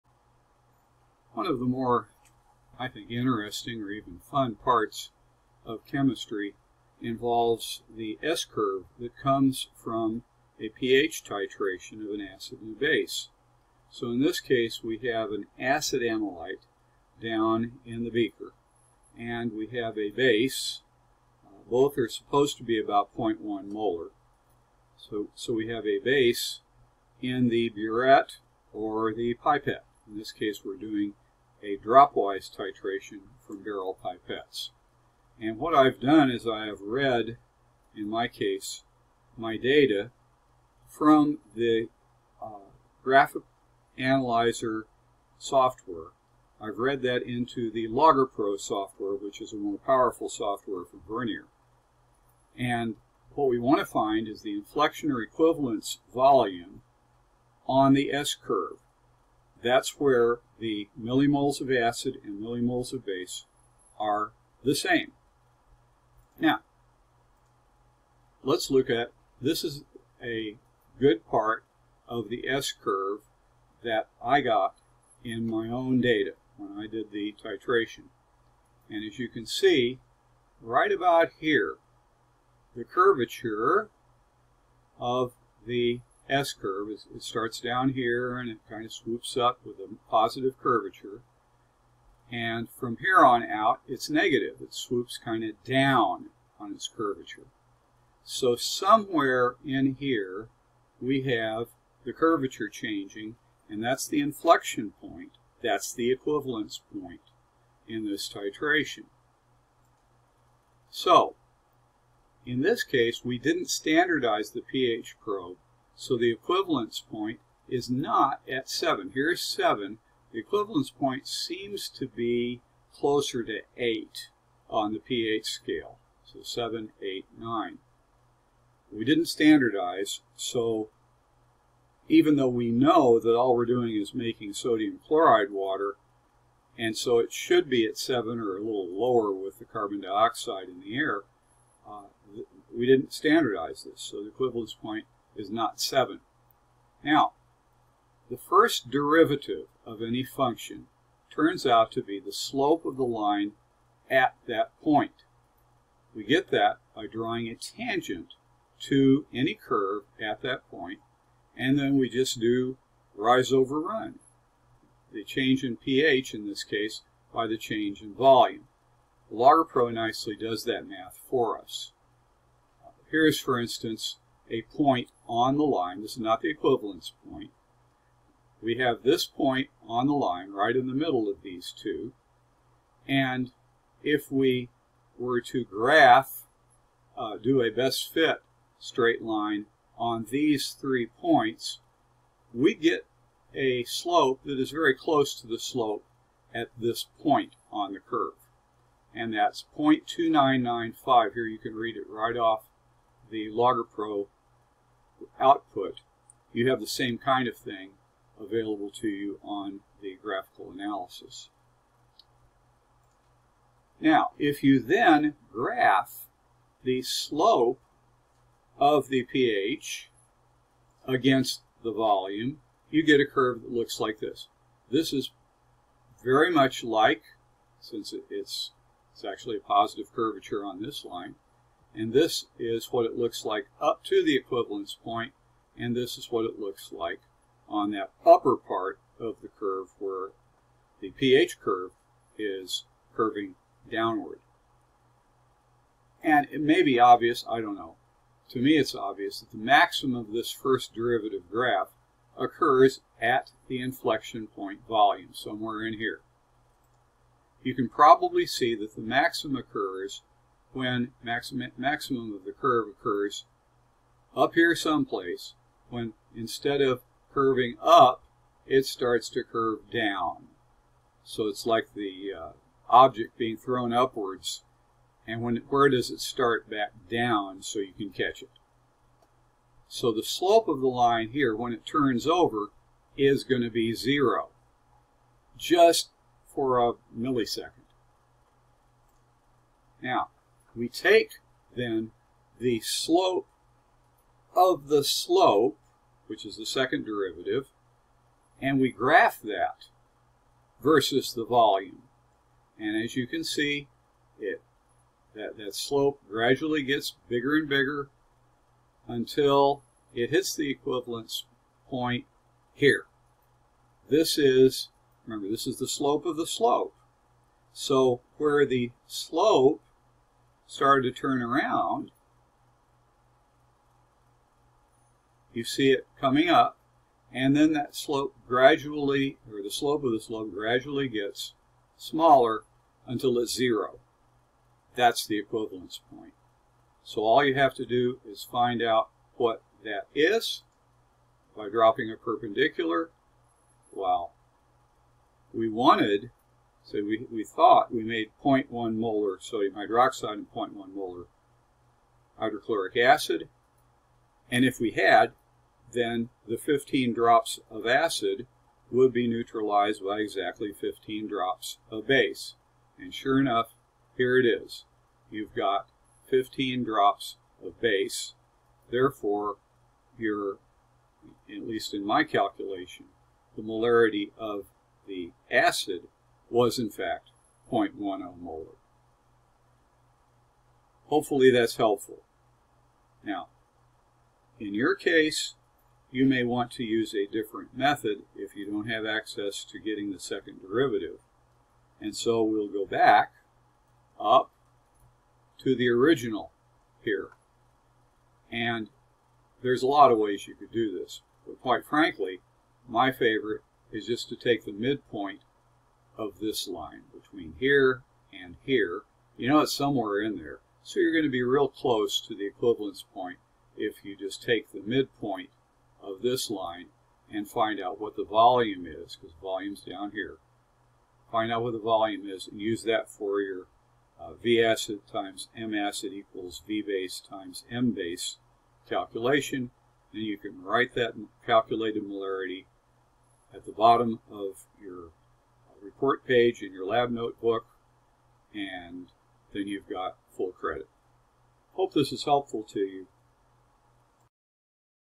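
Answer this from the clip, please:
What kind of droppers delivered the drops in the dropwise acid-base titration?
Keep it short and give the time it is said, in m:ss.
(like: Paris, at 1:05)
Beral pipettes, at 0:33.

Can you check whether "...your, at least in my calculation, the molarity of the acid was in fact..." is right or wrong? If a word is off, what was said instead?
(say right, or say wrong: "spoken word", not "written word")
right.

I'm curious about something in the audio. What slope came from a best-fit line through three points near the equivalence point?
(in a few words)
0.2995.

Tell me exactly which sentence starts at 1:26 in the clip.
It starts down here and it kind of swoops up with a positive curvature.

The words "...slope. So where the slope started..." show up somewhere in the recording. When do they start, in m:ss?
5:16.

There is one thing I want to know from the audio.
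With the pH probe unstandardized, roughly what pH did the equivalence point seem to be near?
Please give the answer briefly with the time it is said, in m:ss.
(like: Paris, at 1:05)
8, at 2:02.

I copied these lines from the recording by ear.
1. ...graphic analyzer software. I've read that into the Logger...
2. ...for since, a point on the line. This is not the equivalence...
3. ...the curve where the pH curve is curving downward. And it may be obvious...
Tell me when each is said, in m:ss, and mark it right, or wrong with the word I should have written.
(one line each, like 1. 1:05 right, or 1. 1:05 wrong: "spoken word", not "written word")
1. 0:43 right
2. 2:53 wrong: "instance", not "since"
3. 3:59 right.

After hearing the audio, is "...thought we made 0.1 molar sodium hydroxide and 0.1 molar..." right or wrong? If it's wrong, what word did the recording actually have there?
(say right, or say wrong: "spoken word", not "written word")
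right.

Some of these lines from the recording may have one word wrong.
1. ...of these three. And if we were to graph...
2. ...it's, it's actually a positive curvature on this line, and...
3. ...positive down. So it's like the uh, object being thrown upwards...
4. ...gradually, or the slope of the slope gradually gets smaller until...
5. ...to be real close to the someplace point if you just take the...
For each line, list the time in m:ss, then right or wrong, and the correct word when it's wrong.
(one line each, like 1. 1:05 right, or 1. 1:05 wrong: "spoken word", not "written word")
1. 3:01 wrong: "two", not "three"
2. 3:48 right
3. 4:29 wrong: "curve", not "positive"
4. 5:28 right
5. 6:51 wrong: "equivalence", not "someplace".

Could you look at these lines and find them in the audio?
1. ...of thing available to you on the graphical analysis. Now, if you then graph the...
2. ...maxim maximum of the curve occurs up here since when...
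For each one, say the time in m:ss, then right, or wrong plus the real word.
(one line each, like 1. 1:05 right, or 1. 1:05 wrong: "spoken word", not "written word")
1. 3:27 right
2. 4:21 wrong: "someplace", not "since".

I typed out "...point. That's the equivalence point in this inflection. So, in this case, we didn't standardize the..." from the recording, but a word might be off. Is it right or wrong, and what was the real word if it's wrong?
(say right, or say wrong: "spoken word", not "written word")
wrong: "titration", not "inflection".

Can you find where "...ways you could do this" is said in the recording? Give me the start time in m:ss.
6:40.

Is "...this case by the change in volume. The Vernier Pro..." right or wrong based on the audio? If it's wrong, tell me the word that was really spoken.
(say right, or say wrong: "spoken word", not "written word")
wrong: "Logger", not "Vernier".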